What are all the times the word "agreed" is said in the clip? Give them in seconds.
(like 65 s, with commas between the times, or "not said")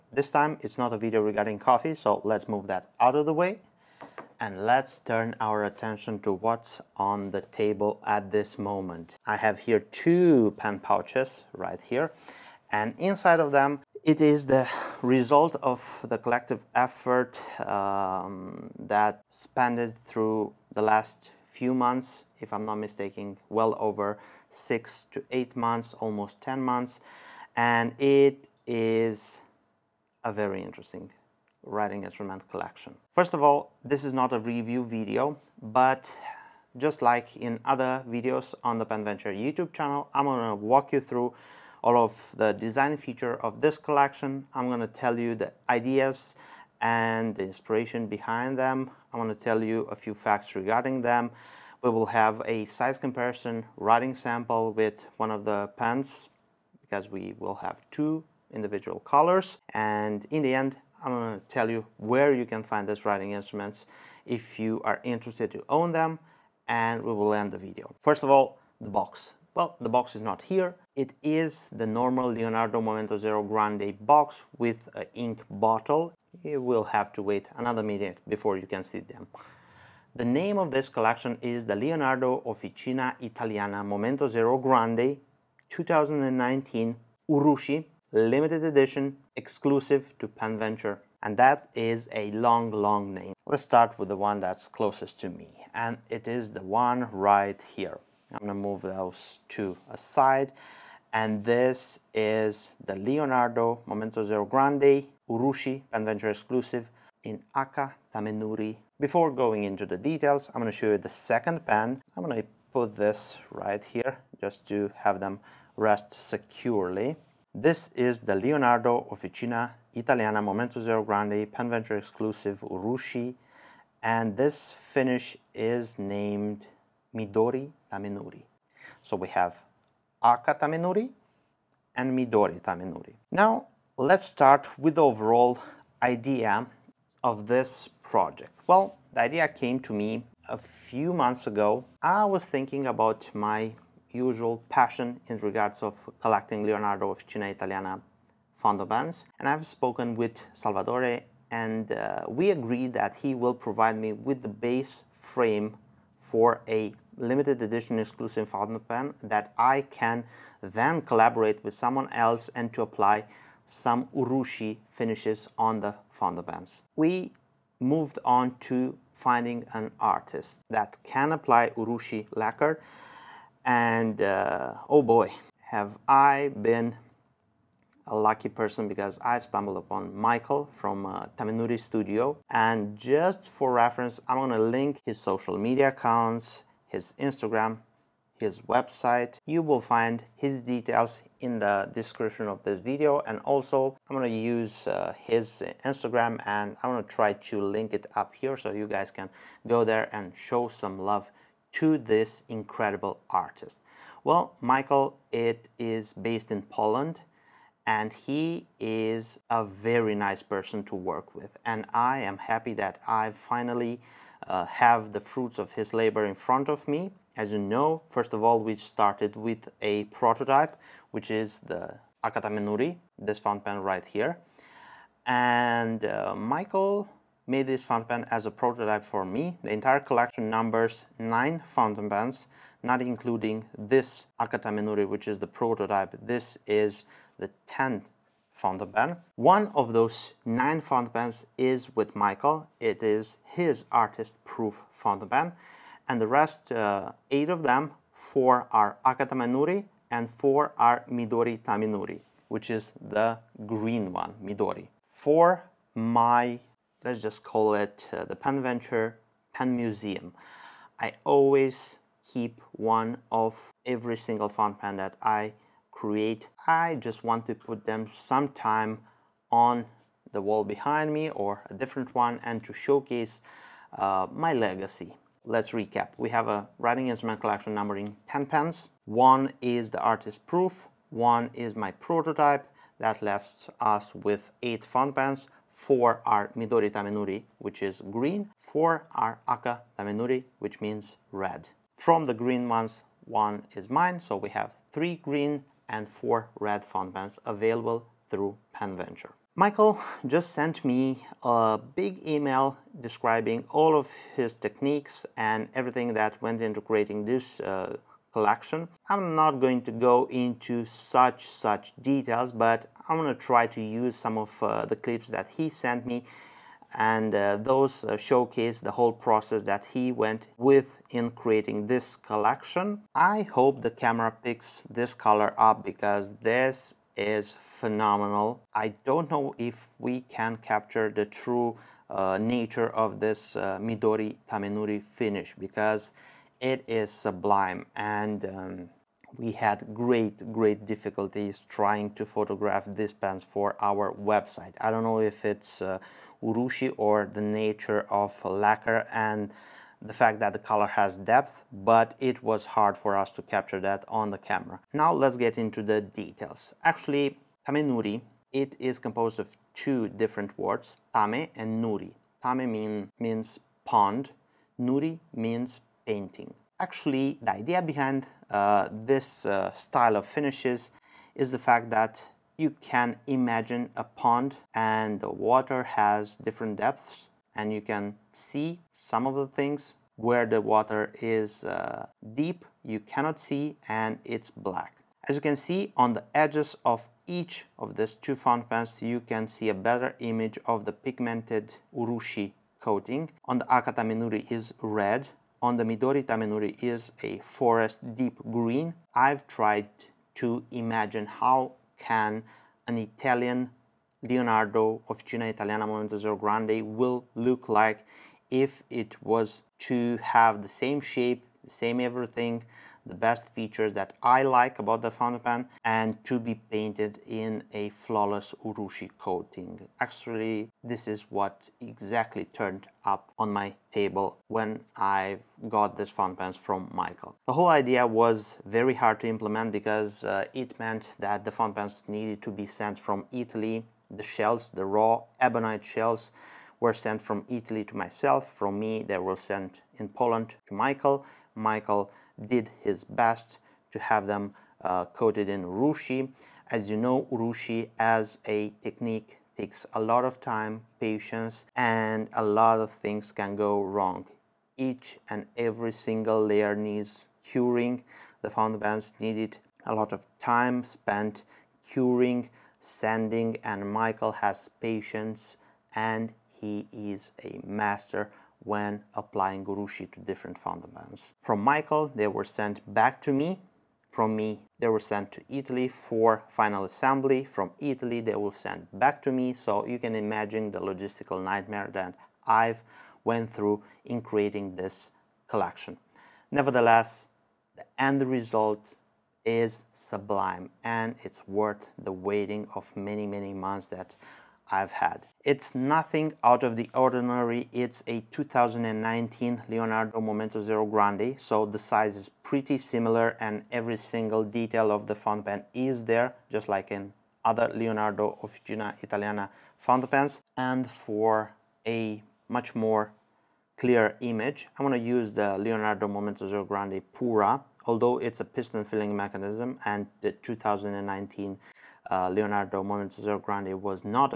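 152 s.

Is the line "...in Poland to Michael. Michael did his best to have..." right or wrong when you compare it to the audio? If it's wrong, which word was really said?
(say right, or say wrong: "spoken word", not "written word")
right.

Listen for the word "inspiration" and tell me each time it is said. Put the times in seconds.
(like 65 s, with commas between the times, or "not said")
47 s.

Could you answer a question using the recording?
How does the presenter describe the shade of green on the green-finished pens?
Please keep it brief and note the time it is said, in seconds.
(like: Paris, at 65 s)
forest deep green, at 397 s.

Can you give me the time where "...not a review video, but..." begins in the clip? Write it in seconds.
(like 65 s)
34 s.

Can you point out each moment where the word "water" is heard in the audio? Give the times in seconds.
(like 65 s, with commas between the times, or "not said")
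375 s, 380 s.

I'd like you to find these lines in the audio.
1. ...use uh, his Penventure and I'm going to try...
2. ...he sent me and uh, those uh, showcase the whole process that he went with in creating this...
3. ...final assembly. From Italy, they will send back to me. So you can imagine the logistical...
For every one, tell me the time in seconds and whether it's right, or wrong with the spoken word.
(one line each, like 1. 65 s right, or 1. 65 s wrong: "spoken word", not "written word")
1. 194 s wrong: "Instagram", not "Penventure"
2. 315 s right
3. 476 s right.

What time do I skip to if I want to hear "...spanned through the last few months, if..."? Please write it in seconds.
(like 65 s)
19 s.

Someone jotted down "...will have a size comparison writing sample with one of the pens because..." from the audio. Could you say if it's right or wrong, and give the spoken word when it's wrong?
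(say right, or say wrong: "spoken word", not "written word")
right.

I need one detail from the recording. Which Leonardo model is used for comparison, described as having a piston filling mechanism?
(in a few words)
Momento Zero Grande Pura.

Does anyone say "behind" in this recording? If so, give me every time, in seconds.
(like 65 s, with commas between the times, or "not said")
48 s, 270 s, 367 s.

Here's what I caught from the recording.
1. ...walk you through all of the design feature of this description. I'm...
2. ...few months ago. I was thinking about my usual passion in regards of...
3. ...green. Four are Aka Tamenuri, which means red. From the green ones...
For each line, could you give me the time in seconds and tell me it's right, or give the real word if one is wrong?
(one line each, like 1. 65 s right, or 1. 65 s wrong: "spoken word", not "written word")
1. 40 s wrong: "collection", not "description"
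2. 140 s right
3. 288 s right.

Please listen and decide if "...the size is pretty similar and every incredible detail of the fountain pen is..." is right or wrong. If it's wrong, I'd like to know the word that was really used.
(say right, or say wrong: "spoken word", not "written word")
wrong: "single", not "incredible".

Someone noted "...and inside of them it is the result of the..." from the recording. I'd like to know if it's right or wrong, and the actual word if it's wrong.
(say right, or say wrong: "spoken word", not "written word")
right.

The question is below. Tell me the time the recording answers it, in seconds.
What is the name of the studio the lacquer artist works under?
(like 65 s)
181 s.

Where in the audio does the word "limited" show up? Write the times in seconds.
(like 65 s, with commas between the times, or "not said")
88 s, 157 s.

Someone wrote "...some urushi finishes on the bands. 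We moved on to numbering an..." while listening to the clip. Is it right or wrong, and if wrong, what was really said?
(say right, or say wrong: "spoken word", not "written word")
wrong: "finding", not "numbering".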